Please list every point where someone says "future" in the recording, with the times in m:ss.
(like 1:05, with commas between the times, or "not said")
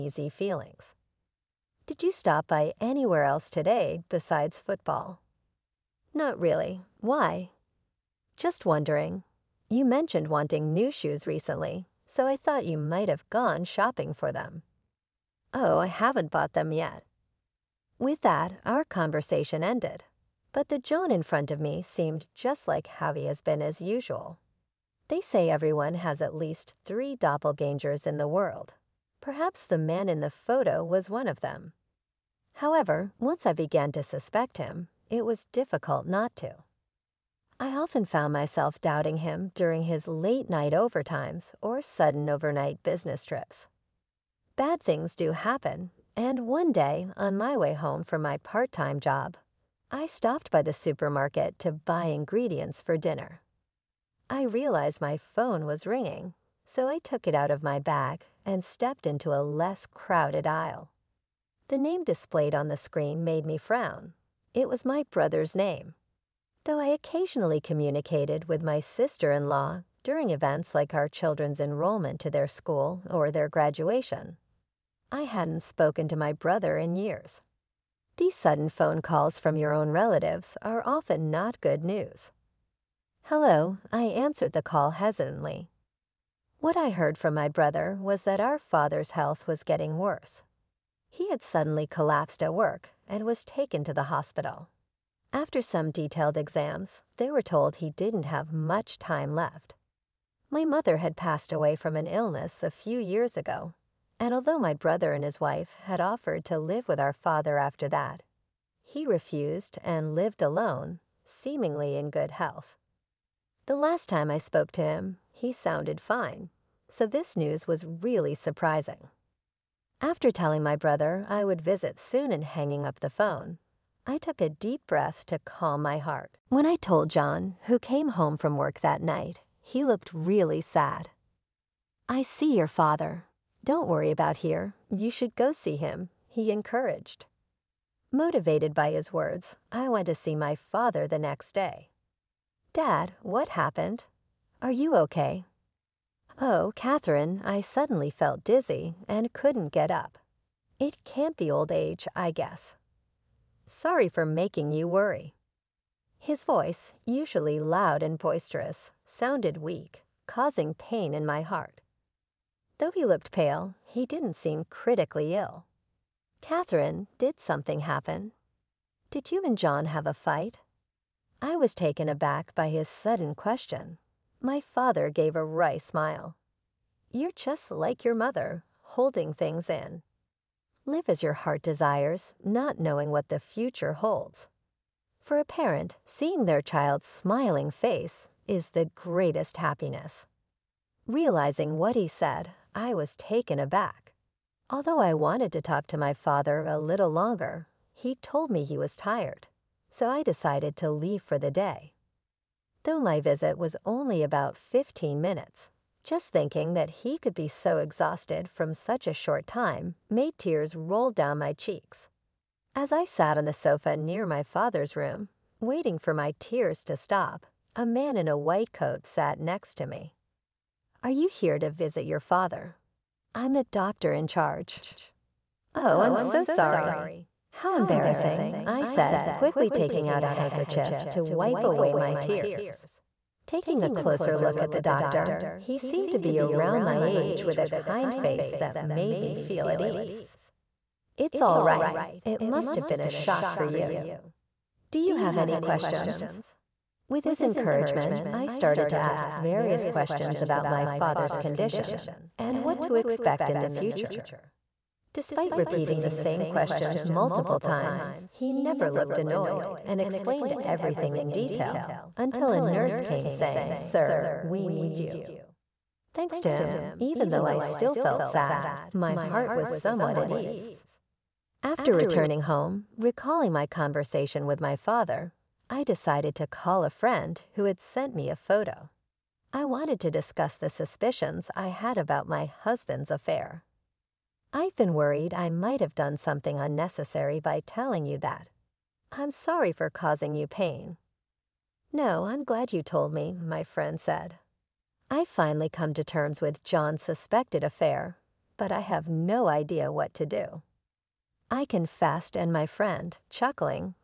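3:03, 4:13.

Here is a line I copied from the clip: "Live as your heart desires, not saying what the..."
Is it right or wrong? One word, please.
wrong.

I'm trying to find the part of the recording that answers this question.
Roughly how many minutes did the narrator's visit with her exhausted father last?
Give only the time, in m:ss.
3:24.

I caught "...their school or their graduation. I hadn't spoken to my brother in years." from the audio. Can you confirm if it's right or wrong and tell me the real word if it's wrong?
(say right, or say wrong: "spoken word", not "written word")
right.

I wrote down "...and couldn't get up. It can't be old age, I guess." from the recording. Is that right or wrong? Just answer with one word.
right.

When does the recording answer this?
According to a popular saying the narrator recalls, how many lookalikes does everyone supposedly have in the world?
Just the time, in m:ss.
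0:26.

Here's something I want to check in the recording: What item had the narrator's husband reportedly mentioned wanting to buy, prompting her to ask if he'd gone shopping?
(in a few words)
new shoes.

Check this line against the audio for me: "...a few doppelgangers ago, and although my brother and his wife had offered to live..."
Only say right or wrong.
wrong.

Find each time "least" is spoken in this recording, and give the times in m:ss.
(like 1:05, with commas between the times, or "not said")
0:26.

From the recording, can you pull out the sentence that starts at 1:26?
What I heard from my brother was that our father's health was getting worse.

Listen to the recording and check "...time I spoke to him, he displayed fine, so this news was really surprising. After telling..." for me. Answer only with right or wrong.
wrong.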